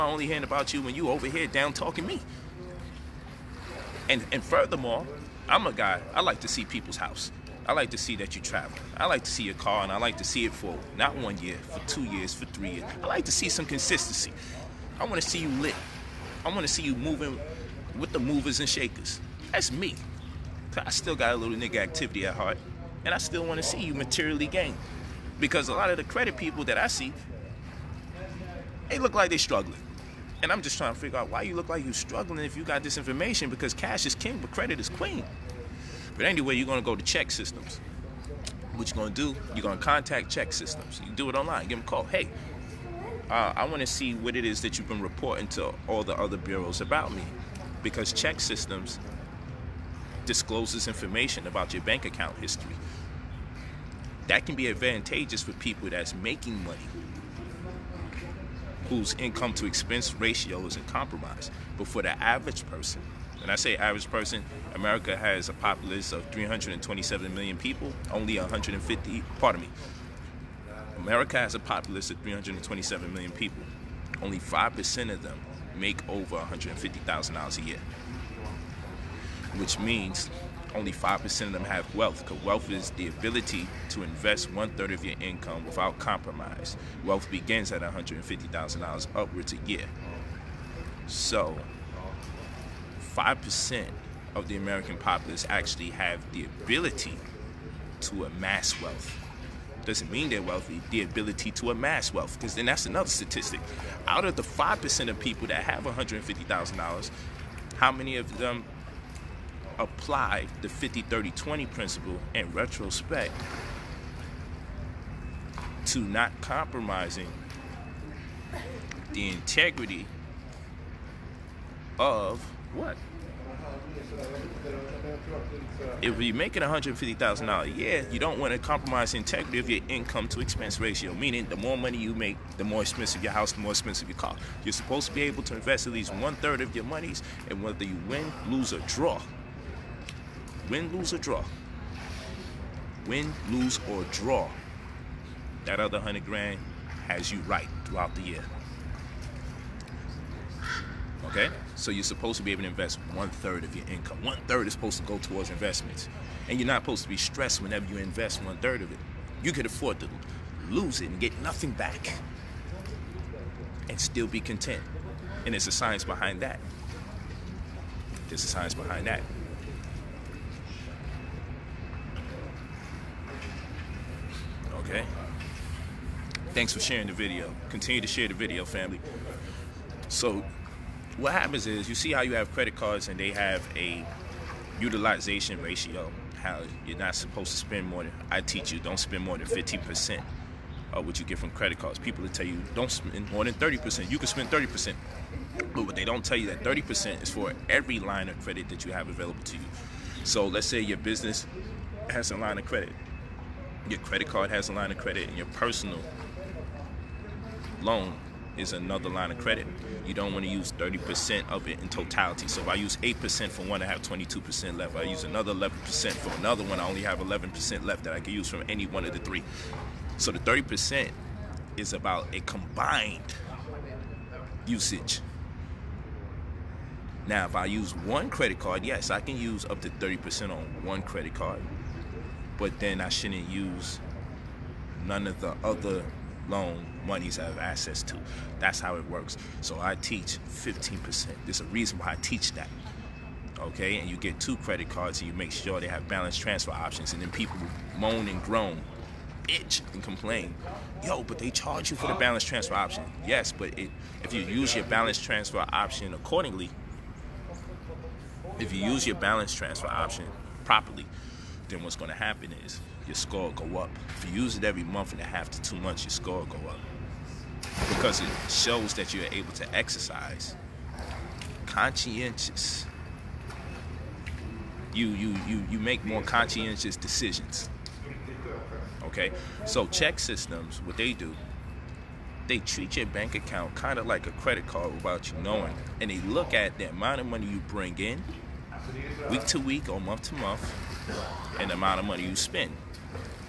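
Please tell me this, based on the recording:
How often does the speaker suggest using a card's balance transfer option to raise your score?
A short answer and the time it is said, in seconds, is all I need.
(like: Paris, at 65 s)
Every 1.5 to 2 months, at 264 s.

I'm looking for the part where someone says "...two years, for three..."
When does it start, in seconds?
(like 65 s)
11 s.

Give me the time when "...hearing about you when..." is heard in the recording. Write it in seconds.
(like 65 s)
0 s.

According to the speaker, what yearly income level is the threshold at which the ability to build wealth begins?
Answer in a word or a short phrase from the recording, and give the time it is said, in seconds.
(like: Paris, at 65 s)
$150,000, at 87 s.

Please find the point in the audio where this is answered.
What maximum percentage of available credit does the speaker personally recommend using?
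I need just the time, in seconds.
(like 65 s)
239 s.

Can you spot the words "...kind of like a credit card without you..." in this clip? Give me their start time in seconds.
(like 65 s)
283 s.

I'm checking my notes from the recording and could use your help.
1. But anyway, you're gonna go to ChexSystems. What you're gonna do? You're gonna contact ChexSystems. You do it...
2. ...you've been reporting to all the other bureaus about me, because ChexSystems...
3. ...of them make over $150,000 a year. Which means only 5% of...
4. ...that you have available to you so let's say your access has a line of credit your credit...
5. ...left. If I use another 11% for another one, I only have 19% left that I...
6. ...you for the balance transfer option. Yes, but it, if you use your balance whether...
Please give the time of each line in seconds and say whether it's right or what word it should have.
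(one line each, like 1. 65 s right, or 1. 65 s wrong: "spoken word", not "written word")
1. 36 s right
2. 44 s right
3. 75 s right
4. 198 s wrong: "business", not "access"
5. 214 s wrong: "11", not "19"
6. 251 s wrong: "transfer", not "whether".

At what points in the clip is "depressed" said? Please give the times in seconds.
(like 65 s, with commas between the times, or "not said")
not said.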